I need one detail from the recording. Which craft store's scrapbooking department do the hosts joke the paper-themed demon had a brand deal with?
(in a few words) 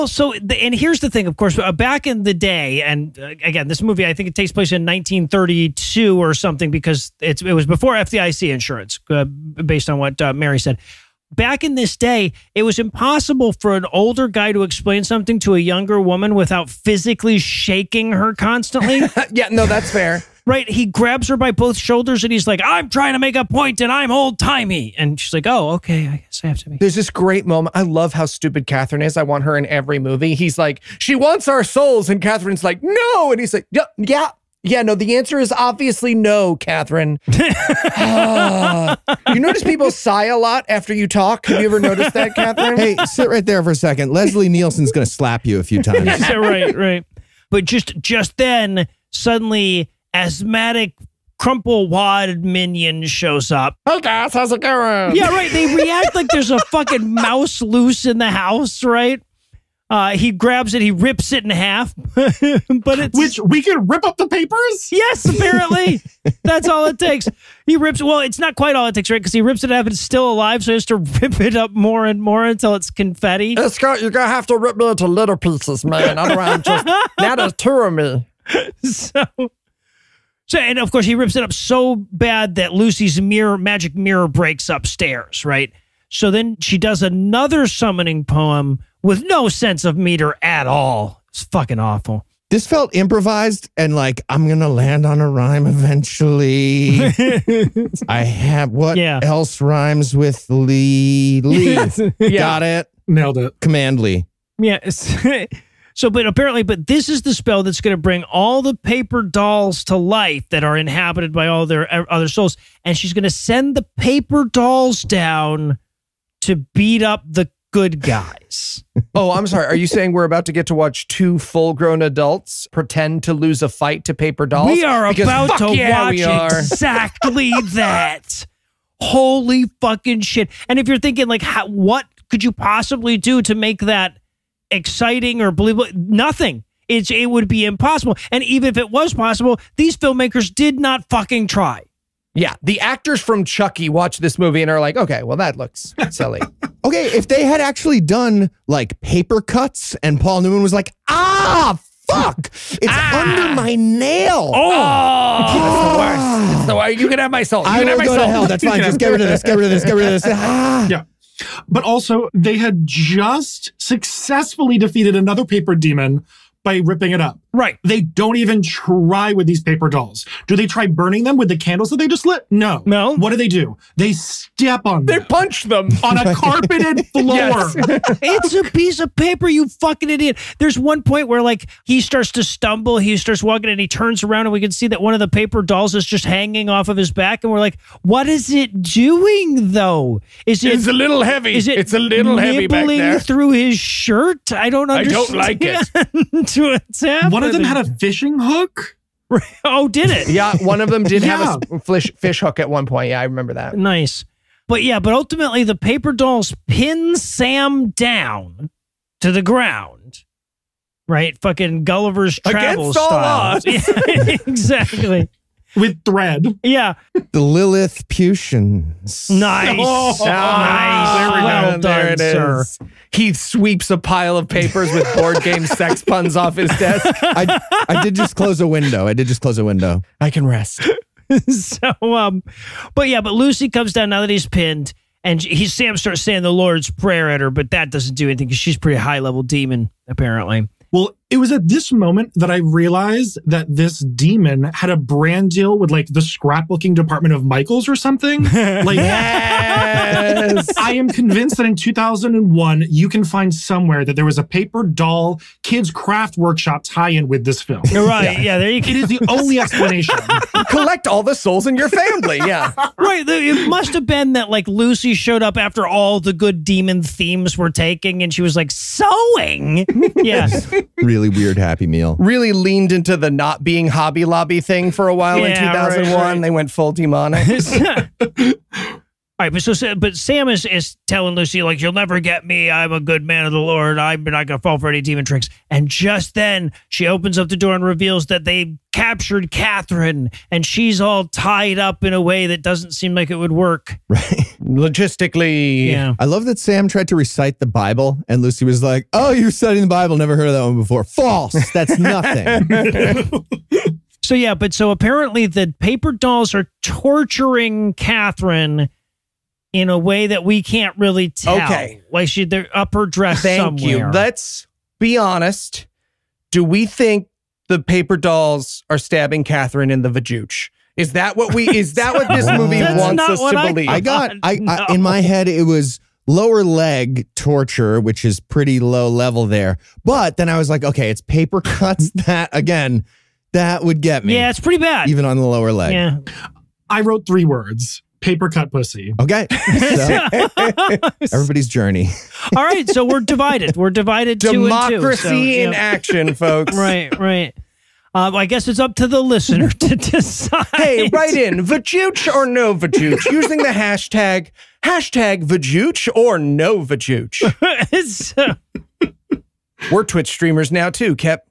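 Michaels.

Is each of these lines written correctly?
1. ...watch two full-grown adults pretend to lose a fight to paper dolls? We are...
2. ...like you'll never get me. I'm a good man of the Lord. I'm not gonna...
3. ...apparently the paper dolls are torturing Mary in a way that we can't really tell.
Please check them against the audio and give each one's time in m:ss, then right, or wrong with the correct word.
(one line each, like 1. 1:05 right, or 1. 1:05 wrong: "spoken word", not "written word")
1. 2:00 right
2. 4:41 right
3. 5:04 wrong: "Catherine", not "Mary".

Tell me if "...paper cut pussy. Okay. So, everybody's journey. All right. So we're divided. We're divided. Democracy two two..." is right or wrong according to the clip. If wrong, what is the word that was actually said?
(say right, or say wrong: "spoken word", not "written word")
right.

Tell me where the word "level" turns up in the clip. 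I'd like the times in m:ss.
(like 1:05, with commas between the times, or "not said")
3:59, 5:29.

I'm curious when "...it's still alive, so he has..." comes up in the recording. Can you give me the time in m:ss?
1:09.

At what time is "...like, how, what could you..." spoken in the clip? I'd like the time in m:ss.
2:11.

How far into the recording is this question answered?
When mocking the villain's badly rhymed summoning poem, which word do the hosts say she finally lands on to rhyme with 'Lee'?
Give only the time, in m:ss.
1:43.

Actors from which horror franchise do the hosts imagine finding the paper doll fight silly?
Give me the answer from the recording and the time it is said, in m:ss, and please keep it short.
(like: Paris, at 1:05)
Chucky, at 2:23.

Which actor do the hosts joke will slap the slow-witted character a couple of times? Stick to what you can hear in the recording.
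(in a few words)
Leslie Nielsen.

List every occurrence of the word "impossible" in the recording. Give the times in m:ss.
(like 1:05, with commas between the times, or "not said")
0:12, 2:17.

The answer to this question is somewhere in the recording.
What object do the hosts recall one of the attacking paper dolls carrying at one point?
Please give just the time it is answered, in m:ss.
3:17.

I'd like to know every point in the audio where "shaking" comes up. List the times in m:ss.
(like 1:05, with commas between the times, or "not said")
0:17.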